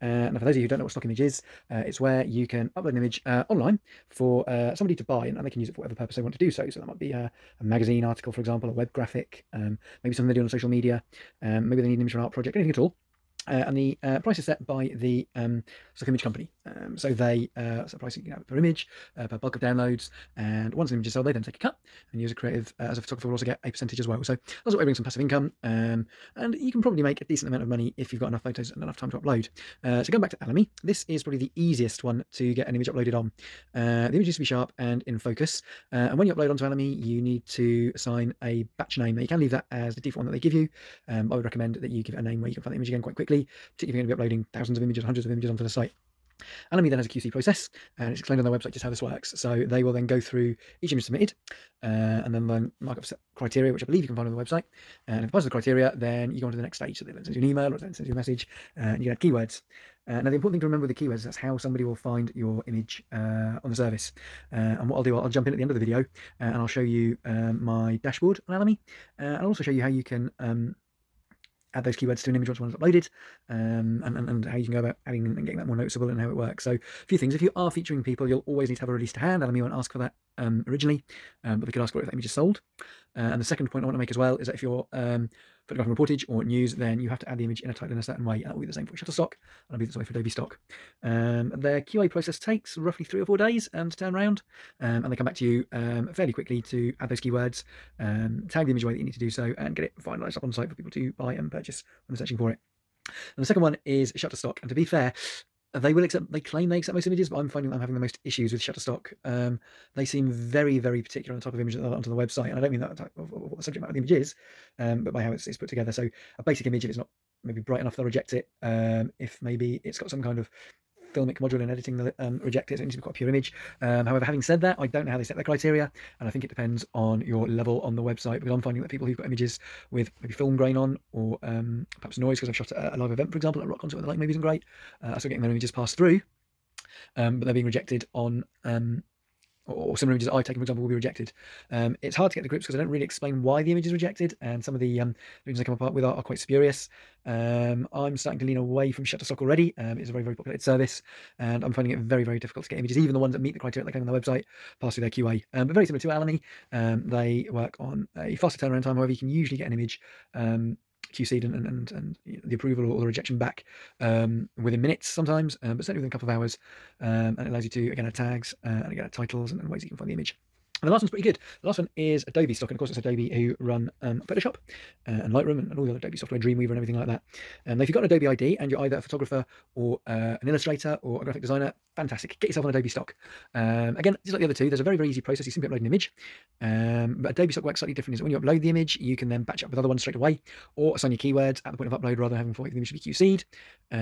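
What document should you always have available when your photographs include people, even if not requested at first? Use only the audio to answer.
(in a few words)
a release.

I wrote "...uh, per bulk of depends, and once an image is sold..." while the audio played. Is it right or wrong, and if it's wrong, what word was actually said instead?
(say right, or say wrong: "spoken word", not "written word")
wrong: "downloads", not "depends".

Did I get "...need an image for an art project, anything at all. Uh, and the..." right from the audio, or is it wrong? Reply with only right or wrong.
right.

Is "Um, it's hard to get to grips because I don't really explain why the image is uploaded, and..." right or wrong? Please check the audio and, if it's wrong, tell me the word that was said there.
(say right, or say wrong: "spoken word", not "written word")
wrong: "rejected", not "uploaded".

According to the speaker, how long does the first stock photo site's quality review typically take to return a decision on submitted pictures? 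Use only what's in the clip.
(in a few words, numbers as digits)
3 or 4 days.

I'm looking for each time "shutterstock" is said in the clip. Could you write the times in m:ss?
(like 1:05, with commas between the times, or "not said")
1:28, 1:44, 1:48, 2:29.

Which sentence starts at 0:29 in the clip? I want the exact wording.
Uh, so going back to Alamy, this is probably the easiest one to get an image uploaded on.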